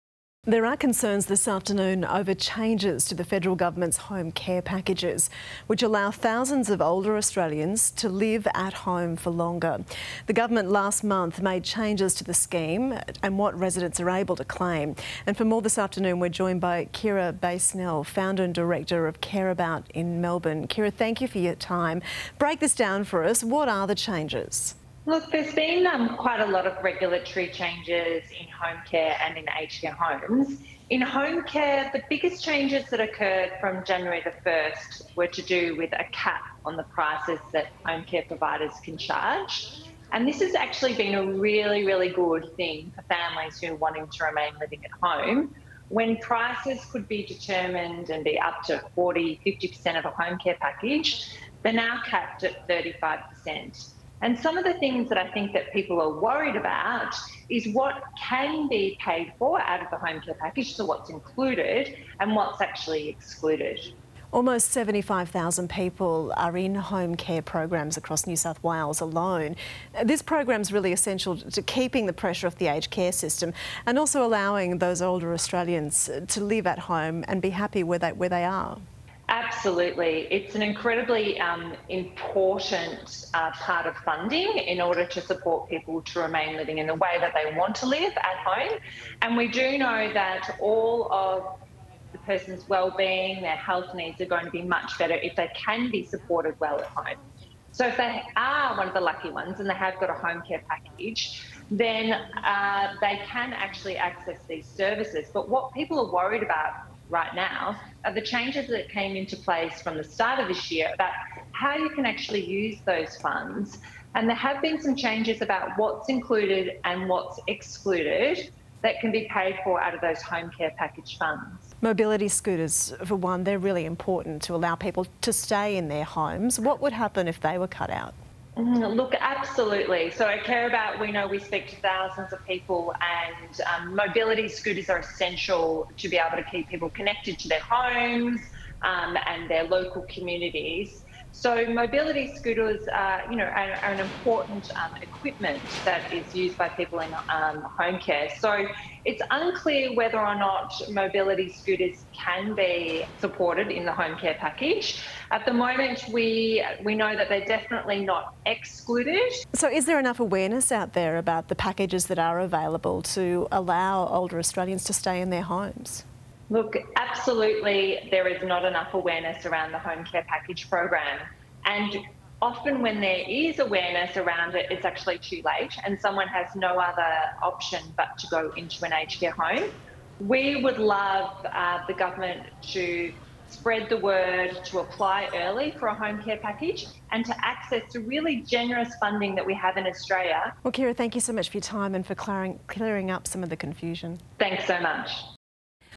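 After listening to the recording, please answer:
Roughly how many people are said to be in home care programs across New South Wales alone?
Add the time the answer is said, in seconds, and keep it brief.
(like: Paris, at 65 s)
75,000, at 64 s.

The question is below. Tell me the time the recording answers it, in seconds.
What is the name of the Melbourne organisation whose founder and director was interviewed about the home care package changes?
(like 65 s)
19 s.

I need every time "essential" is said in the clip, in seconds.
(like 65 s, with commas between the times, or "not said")
70 s, 134 s.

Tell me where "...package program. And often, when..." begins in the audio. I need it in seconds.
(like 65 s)
170 s.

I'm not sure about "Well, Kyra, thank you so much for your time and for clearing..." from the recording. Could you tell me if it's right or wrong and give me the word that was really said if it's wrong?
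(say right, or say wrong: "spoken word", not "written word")
right.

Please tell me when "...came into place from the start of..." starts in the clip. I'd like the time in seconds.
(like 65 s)
108 s.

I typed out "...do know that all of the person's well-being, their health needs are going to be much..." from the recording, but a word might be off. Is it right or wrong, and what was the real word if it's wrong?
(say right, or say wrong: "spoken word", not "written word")
right.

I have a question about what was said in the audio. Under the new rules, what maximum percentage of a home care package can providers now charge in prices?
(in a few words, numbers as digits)
35%.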